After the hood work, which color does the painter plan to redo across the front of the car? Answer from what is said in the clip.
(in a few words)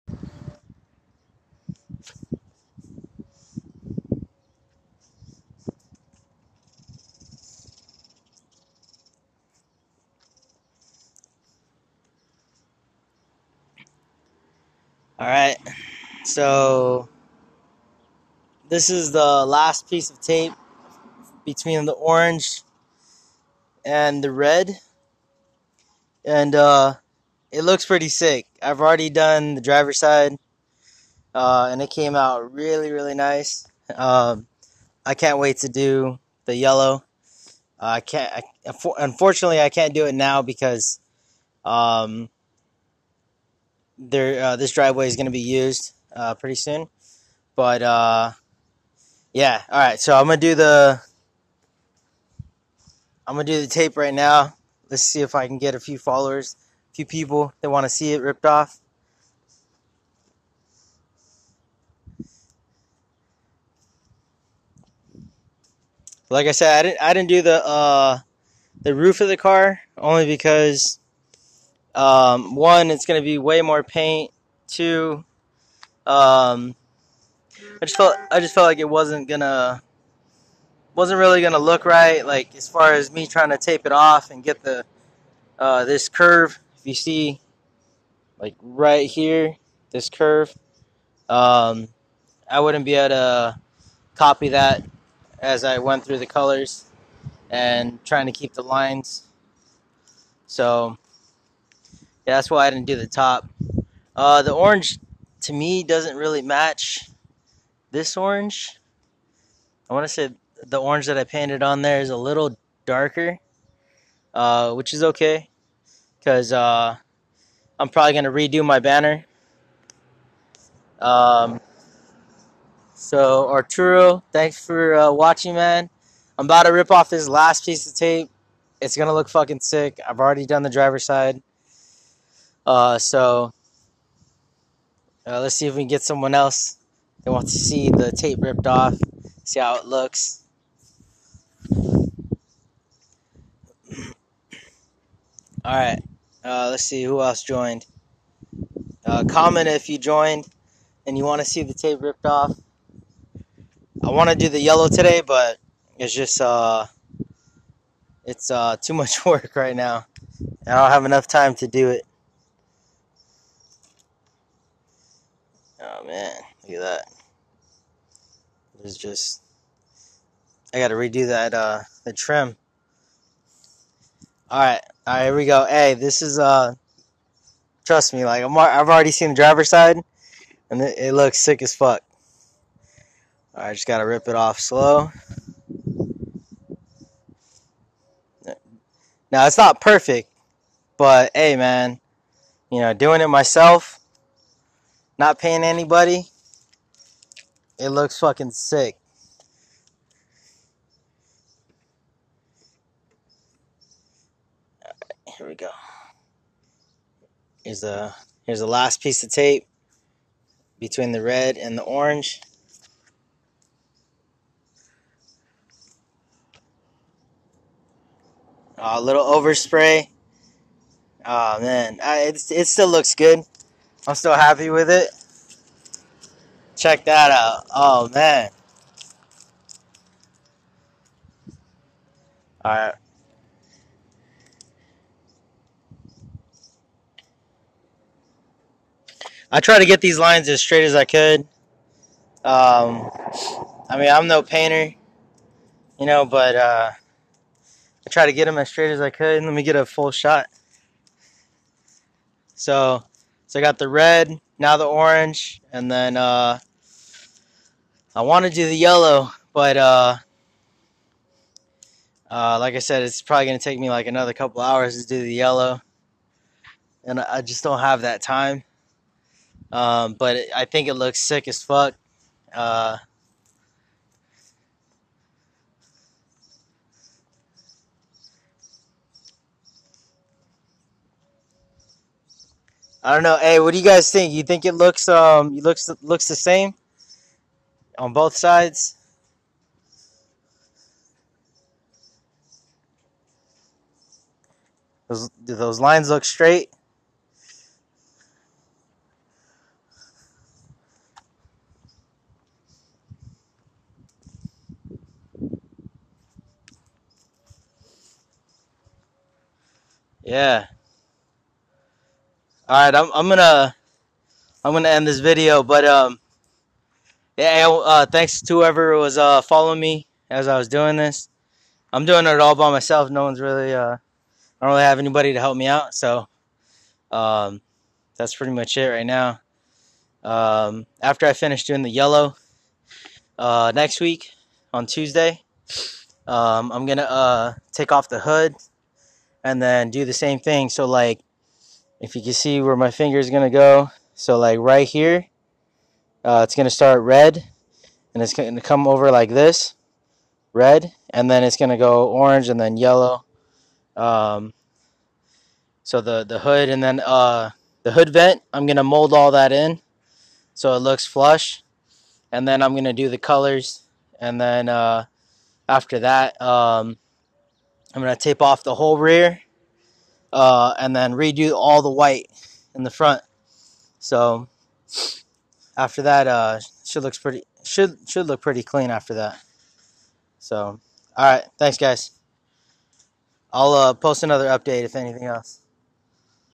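White.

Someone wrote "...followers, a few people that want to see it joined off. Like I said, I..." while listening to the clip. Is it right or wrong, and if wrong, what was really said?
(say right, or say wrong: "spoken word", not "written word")
wrong: "ripped", not "joined".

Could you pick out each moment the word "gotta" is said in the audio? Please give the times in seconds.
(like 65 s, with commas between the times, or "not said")
170 s, 183 s.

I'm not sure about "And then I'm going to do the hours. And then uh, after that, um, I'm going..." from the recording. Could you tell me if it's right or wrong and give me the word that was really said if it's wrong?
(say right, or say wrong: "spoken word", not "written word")
wrong: "colors", not "hours".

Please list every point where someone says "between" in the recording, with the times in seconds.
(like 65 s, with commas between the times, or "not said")
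21 s, 210 s.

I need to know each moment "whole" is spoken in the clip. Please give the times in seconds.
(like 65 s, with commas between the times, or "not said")
368 s.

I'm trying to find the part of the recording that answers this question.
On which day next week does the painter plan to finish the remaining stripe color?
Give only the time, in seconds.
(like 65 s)
334 s.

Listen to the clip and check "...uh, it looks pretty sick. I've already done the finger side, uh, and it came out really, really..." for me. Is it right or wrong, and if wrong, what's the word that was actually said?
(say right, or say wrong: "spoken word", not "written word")
wrong: "driver", not "finger".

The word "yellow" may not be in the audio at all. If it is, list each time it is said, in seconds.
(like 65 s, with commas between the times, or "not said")
36 s, 154 s, 258 s, 265 s, 331 s, 352 s.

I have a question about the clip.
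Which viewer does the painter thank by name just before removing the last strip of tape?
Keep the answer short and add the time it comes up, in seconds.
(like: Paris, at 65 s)
Arturo, at 123 s.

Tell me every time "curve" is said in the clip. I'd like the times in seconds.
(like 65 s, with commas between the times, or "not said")
86 s, 90 s.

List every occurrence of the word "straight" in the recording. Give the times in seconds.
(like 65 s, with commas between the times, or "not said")
240 s, 248 s, 296 s.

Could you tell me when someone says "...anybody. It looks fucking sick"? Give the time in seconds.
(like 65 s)
195 s.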